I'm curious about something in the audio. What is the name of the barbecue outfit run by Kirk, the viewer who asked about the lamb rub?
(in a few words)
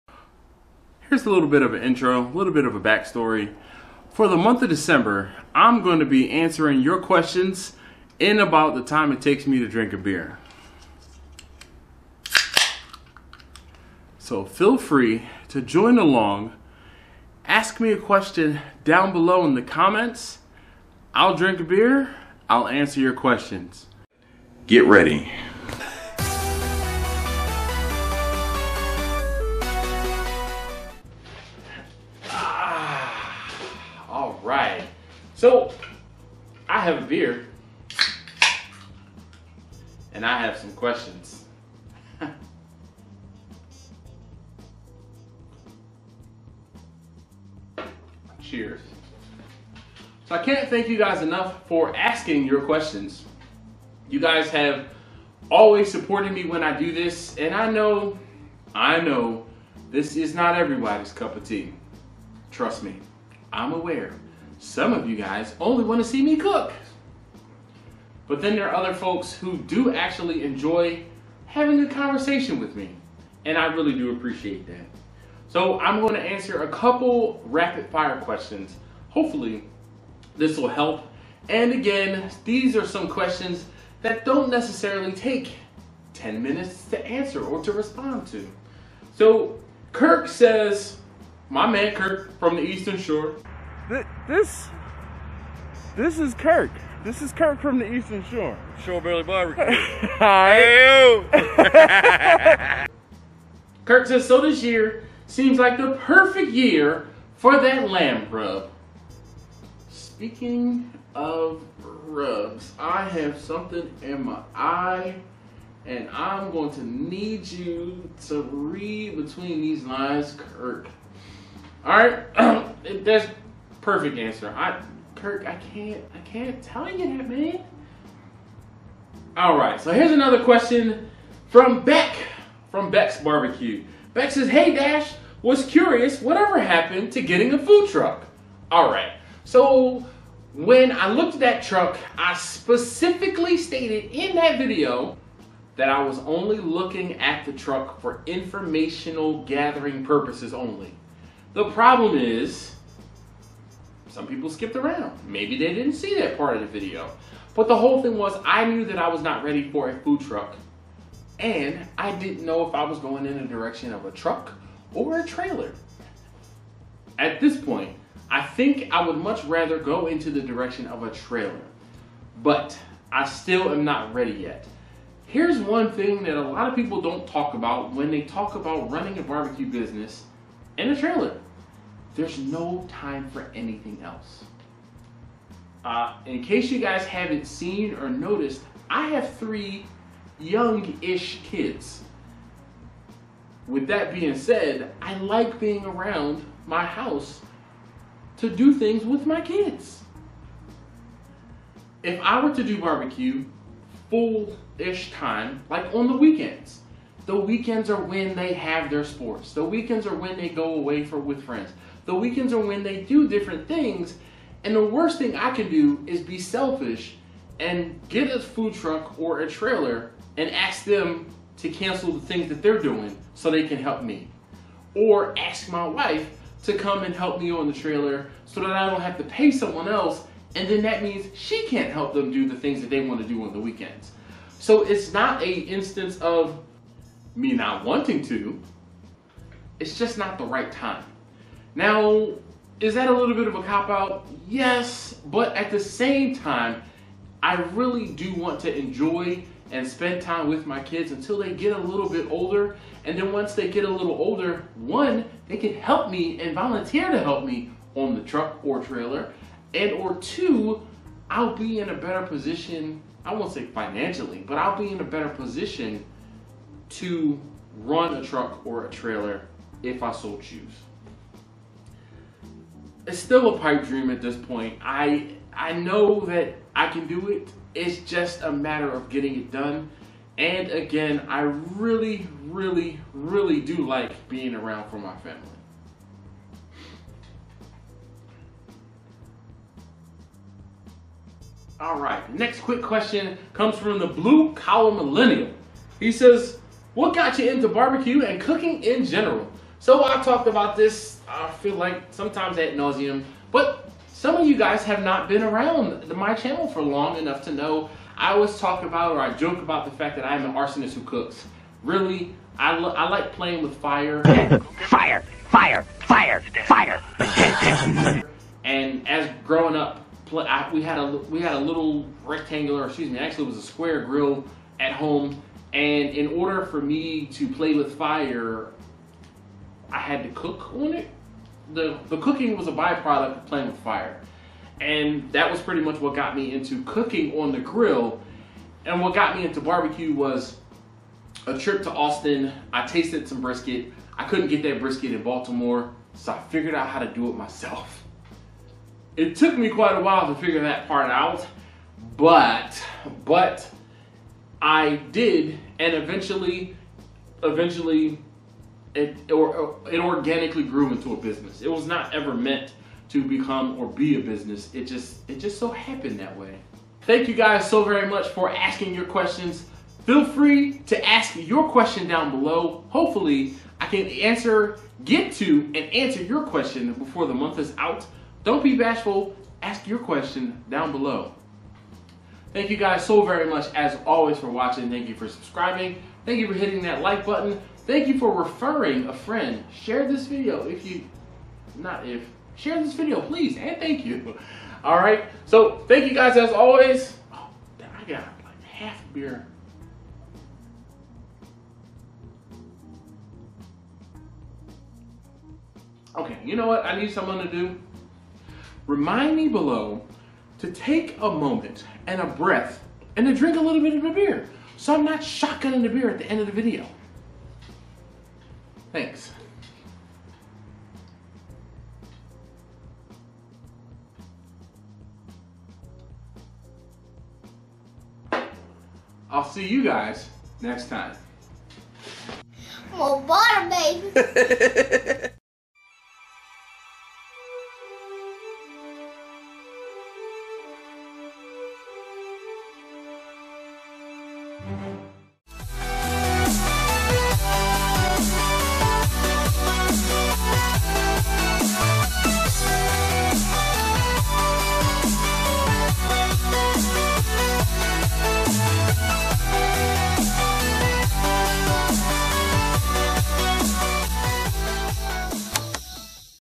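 Shore Barbecue.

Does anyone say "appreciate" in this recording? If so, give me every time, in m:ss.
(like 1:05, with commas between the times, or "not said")
1:14.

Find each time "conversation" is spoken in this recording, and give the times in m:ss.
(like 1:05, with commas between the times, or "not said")
1:11.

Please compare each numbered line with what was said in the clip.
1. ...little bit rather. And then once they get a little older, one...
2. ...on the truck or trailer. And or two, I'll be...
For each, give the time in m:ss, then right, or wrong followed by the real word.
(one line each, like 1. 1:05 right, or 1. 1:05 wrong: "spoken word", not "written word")
1. 4:11 wrong: "older", not "rather"
2. 4:17 right.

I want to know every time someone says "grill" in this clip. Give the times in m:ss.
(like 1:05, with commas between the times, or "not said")
5:24, 5:37.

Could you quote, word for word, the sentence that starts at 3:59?
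It's just not the right time.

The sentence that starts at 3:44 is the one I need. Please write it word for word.
Or ask my wife to come and help me on the trailer so that I don't have to pay someone else.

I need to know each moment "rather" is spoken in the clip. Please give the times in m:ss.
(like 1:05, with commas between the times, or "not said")
2:49.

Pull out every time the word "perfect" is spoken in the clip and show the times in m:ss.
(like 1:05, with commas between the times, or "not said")
1:46, 2:03.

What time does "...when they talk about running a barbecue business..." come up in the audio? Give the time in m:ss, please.
2:57.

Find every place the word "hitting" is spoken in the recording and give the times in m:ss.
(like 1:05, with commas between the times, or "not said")
6:26.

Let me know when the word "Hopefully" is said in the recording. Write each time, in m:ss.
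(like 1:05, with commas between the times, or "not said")
1:19, 6:12.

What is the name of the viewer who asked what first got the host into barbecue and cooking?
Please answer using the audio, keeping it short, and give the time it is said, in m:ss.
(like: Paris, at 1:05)
the blue collar millennial, at 4:53.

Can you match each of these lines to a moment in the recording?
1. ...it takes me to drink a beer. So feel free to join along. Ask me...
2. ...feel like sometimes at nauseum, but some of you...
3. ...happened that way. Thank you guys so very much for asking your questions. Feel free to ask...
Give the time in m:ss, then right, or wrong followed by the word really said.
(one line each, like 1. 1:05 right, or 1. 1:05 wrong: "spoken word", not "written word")
1. 0:09 right
2. 5:01 right
3. 6:05 right.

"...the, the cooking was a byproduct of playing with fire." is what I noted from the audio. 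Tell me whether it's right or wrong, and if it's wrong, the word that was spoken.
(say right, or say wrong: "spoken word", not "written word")
right.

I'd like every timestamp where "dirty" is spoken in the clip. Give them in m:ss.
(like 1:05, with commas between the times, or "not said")
not said.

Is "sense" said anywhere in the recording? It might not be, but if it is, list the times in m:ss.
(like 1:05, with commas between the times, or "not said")
not said.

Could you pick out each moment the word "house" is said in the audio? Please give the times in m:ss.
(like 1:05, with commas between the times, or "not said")
3:16.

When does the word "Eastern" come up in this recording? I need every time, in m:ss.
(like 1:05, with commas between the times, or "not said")
1:32, 1:37.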